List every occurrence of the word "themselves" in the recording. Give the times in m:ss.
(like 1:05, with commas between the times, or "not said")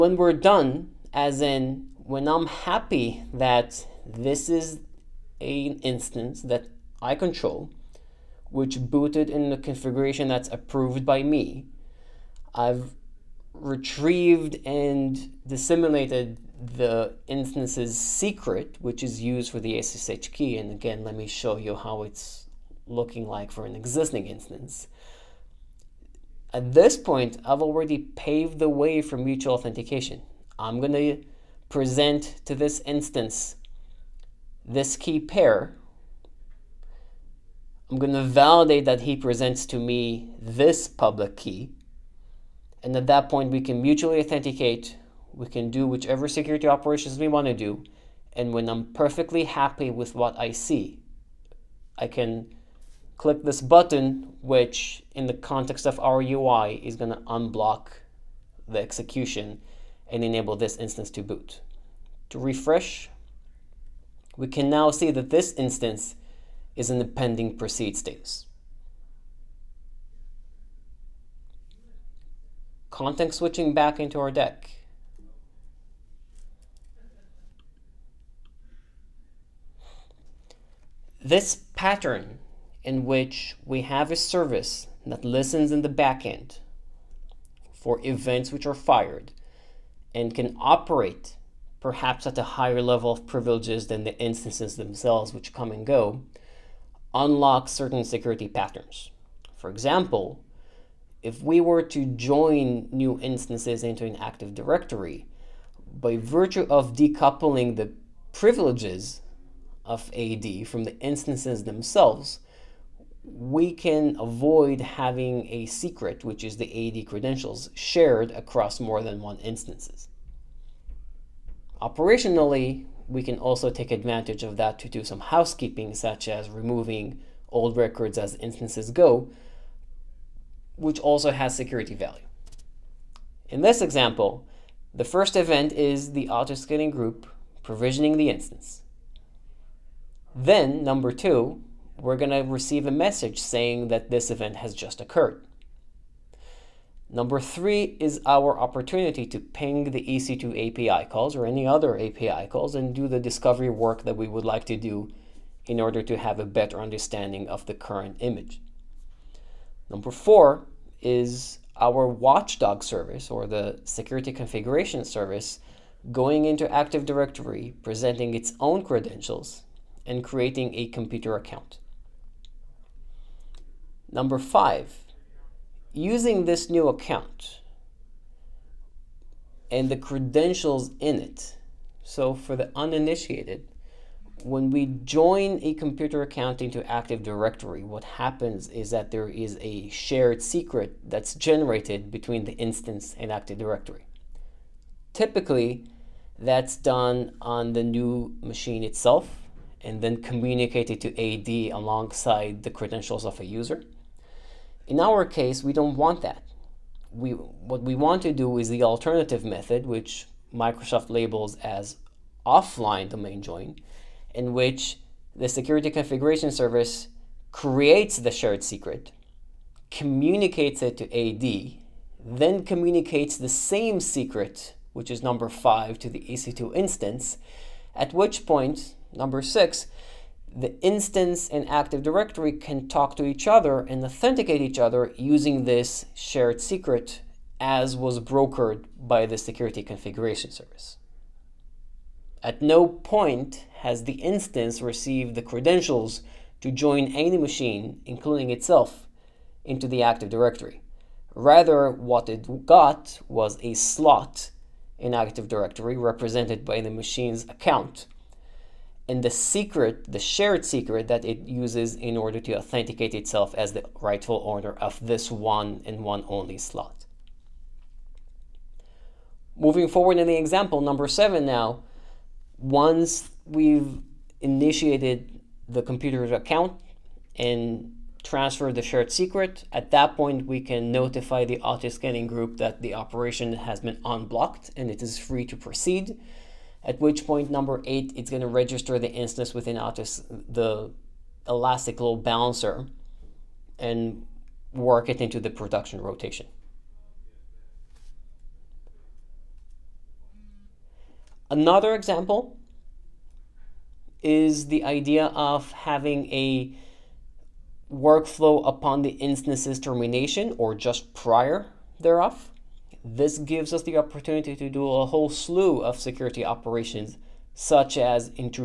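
1:34, 1:51.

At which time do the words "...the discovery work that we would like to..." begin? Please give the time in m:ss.
2:33.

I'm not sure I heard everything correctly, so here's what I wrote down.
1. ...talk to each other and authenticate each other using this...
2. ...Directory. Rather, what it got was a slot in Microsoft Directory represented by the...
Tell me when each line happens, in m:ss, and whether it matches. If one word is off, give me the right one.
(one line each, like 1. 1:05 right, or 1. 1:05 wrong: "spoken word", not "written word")
1. 3:52 right
2. 4:10 wrong: "Active", not "Microsoft".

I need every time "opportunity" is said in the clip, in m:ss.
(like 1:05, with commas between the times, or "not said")
2:28, 5:13.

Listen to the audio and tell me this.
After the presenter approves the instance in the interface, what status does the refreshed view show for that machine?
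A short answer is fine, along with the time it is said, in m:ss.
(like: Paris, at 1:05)
pending proceed, at 1:07.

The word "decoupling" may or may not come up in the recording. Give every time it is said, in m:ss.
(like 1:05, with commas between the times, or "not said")
1:46.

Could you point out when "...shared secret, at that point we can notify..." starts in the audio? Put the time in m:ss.
4:38.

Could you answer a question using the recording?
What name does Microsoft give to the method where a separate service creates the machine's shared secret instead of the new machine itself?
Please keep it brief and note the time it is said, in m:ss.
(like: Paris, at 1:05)
offline domain join, at 3:32.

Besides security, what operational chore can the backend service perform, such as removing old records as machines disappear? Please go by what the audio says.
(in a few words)
housekeeping.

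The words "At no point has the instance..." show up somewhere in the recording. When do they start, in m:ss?
4:02.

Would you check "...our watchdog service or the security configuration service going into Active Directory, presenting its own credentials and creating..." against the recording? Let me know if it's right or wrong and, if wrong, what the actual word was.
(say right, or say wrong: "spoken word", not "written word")
right.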